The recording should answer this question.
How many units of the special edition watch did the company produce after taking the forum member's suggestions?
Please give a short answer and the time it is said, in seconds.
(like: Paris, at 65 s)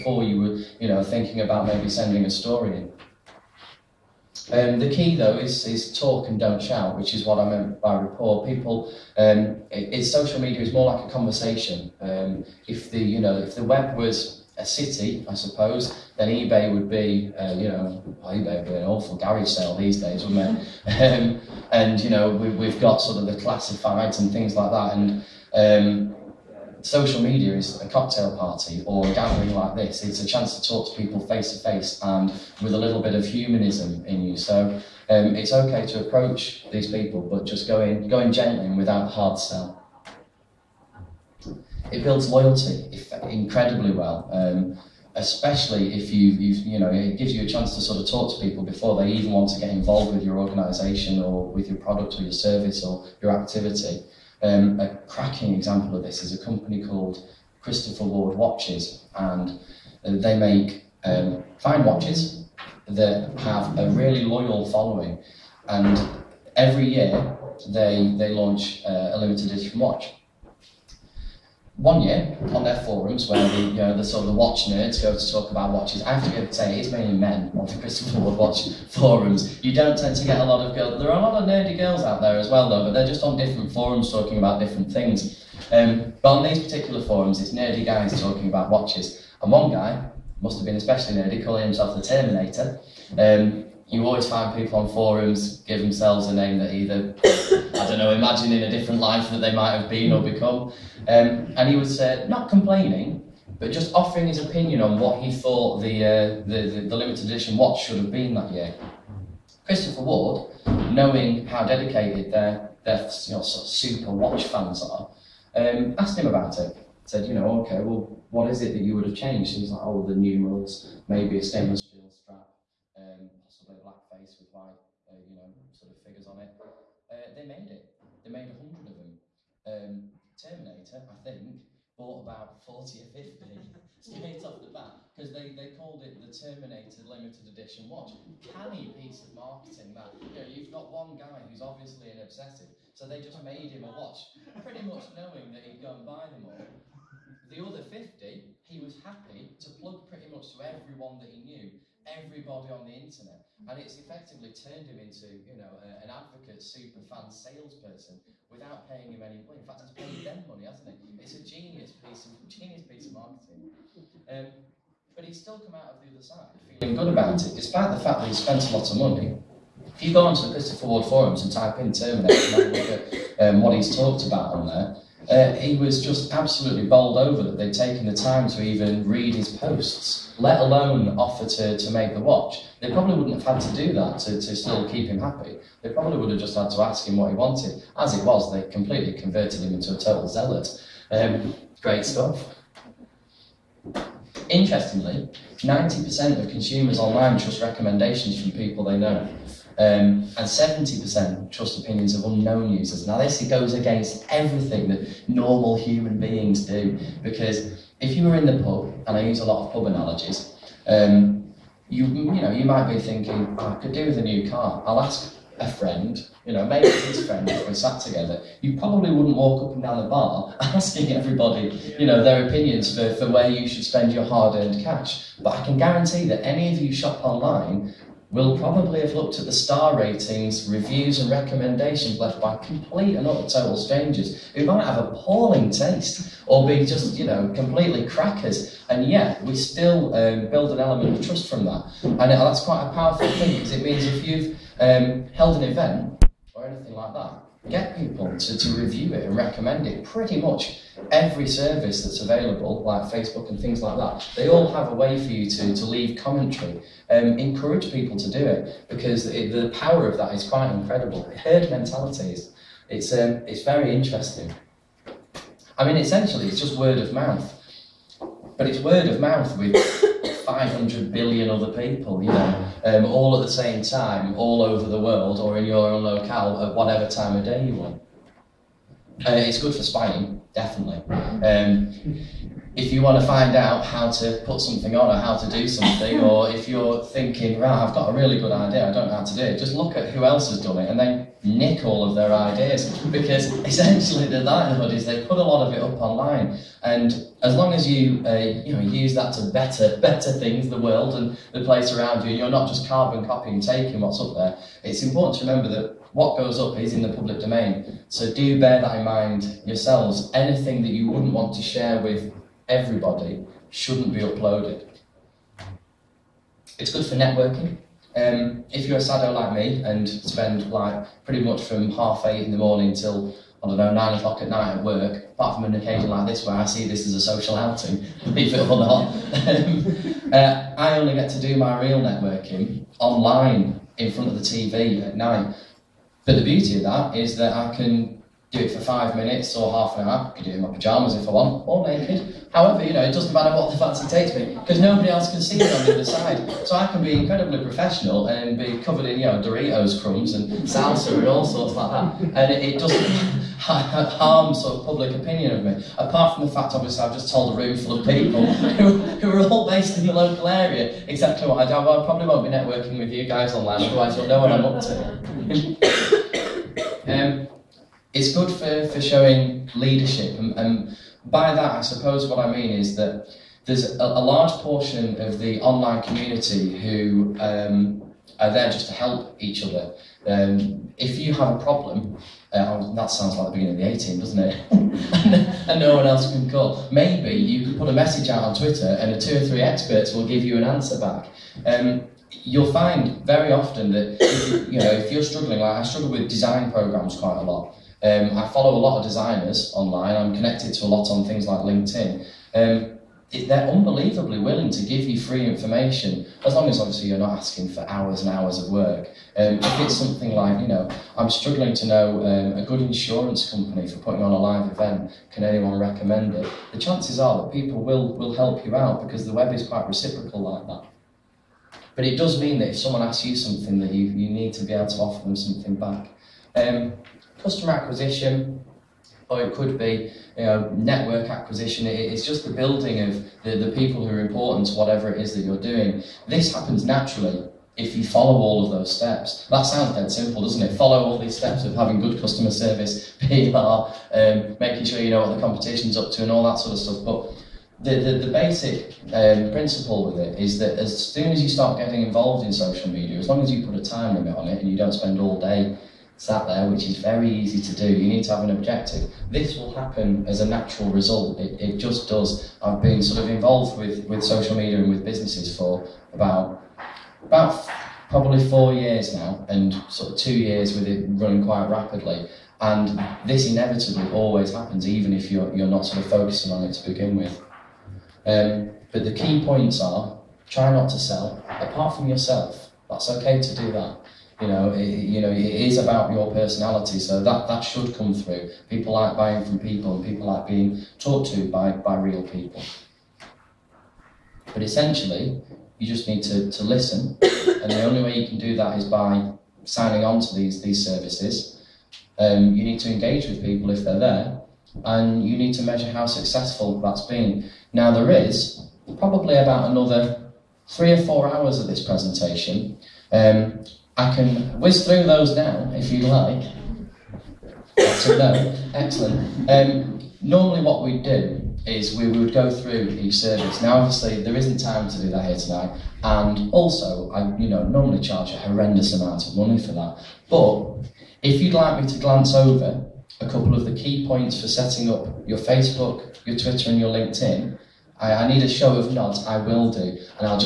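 100, at 128 s.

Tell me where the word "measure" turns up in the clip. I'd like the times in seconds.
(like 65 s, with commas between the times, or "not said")
505 s.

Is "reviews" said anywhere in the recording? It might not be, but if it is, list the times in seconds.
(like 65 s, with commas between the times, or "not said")
230 s, 248 s.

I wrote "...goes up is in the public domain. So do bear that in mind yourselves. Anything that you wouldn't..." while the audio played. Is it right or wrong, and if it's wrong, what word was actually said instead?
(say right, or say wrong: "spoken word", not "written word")
right.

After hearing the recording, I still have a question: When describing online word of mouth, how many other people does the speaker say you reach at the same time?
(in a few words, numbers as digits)
500 billion.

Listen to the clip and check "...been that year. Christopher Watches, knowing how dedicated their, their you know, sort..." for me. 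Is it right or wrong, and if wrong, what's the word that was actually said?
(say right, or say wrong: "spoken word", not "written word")
wrong: "Ward", not "Watches".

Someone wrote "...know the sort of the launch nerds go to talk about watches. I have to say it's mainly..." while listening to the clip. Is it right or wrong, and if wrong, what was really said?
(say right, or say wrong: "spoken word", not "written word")
wrong: "watch", not "launch".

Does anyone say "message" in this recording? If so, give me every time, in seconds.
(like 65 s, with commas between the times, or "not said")
387 s.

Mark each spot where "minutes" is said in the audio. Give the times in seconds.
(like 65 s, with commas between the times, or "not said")
339 s.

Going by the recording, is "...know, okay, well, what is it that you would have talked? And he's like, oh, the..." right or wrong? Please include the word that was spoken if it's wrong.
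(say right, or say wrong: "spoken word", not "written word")
wrong: "changed", not "talked".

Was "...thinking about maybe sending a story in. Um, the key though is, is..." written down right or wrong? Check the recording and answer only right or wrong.
right.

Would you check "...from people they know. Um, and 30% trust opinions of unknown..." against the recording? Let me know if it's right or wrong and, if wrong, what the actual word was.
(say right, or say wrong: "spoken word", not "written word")
wrong: "70", not "30".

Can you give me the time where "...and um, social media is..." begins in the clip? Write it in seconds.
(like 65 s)
24 s.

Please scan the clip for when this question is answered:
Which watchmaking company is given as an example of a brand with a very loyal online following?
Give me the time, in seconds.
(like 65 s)
57 s.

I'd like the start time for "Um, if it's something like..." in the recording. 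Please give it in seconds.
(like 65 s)
409 s.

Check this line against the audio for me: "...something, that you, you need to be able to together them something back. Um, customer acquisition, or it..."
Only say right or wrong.
wrong.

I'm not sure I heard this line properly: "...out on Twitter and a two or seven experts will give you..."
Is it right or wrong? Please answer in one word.
wrong.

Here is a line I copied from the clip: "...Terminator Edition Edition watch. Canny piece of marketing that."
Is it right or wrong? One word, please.
wrong.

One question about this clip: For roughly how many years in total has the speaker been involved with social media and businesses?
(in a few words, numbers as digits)
4 years.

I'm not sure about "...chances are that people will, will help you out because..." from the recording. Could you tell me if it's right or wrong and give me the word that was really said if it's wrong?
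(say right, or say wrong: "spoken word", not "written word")
right.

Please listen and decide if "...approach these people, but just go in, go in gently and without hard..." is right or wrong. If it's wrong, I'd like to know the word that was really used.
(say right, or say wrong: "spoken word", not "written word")
right.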